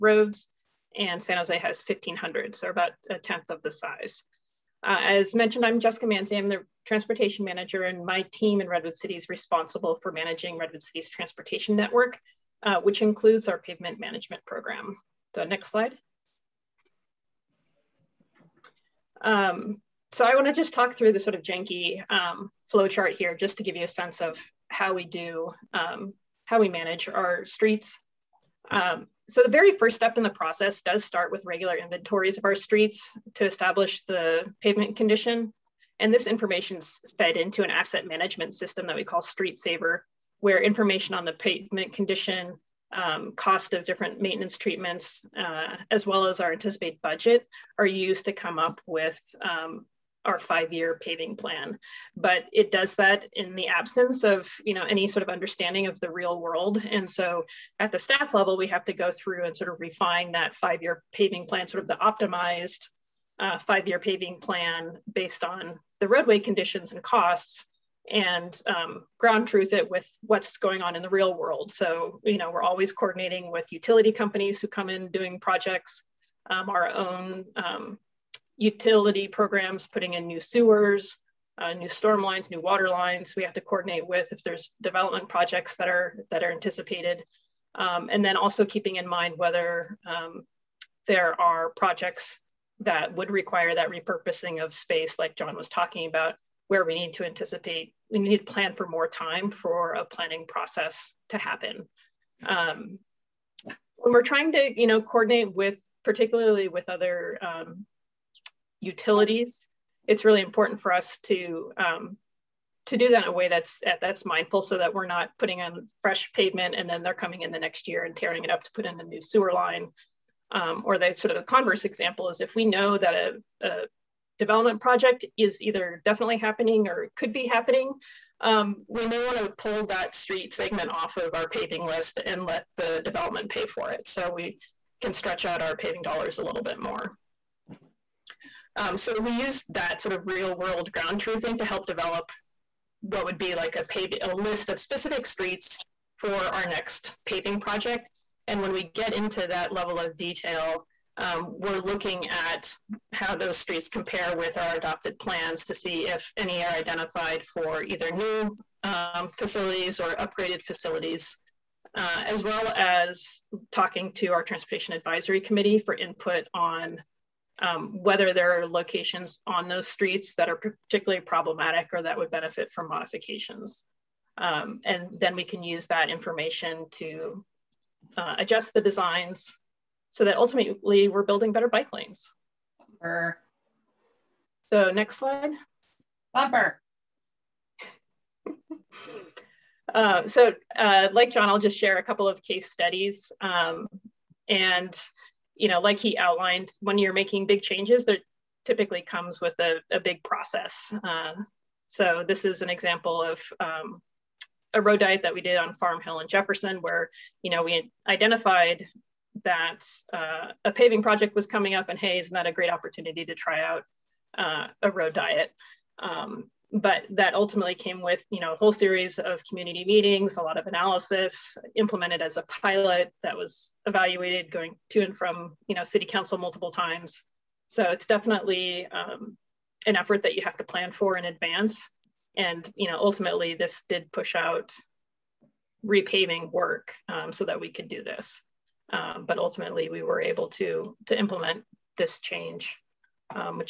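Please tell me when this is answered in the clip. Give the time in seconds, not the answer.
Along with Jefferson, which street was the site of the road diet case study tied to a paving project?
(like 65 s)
205 s.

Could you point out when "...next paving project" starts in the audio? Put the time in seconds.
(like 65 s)
146 s.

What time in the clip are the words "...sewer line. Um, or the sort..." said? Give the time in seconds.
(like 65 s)
119 s.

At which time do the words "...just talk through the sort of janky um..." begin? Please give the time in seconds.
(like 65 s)
20 s.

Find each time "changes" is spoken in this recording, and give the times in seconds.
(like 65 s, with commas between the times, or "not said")
197 s, 242 s.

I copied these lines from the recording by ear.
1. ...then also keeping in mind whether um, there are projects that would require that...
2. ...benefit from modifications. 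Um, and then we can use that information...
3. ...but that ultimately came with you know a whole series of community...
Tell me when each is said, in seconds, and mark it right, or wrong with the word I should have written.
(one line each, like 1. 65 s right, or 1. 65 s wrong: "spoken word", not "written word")
1. 88 s right
2. 172 s right
3. 216 s right.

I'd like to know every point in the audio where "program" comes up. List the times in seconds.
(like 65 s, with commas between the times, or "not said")
14 s, 79 s.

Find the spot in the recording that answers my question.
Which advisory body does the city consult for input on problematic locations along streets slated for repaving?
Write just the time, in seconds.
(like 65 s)
164 s.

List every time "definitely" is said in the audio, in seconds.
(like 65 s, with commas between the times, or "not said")
126 s, 228 s.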